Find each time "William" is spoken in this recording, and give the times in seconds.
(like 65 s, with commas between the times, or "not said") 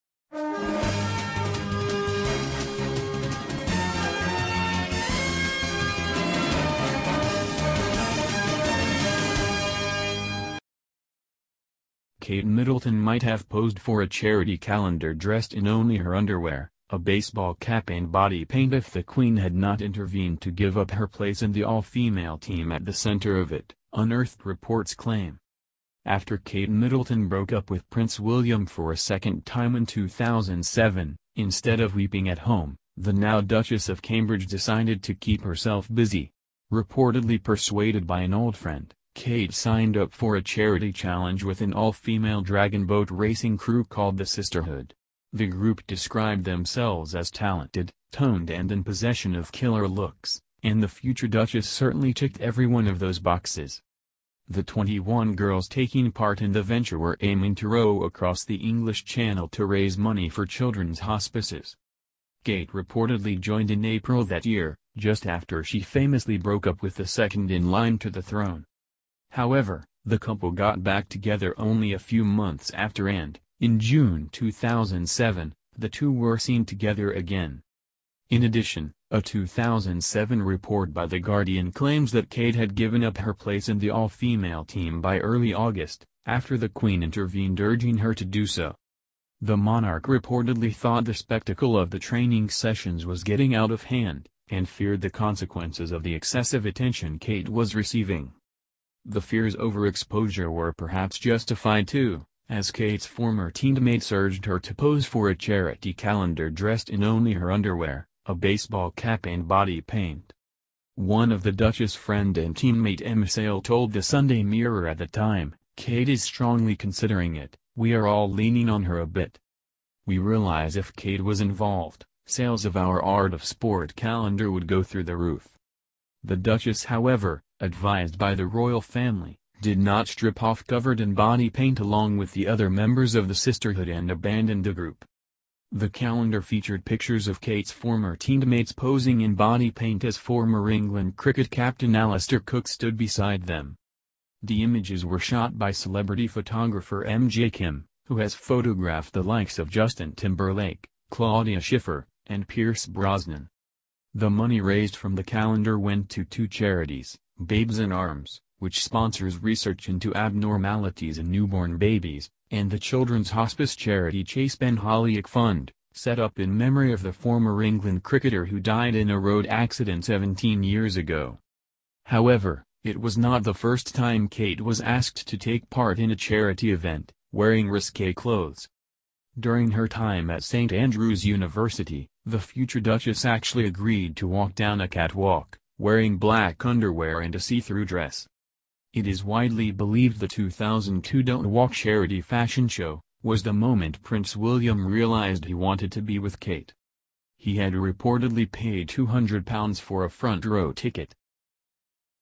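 28 s, 194 s.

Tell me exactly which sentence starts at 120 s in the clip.
We realize if Kate was involved, sales of our Art of Sport calendar would go through the roof.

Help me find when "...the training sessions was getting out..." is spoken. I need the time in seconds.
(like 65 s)
91 s.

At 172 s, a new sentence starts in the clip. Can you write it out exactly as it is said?
However, it was not the first time Kate was asked to take part in a charity event, wearing risque clothes.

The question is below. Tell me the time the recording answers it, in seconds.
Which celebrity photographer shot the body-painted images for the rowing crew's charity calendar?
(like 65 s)
147 s.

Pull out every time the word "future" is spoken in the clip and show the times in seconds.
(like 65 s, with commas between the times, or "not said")
50 s, 182 s.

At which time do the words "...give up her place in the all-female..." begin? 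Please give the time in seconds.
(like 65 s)
20 s.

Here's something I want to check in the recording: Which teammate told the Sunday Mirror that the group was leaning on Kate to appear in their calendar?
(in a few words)
Emma Sale.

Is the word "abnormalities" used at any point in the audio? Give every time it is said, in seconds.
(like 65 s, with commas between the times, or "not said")
160 s.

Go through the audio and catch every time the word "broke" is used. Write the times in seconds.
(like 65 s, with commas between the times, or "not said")
27 s, 66 s.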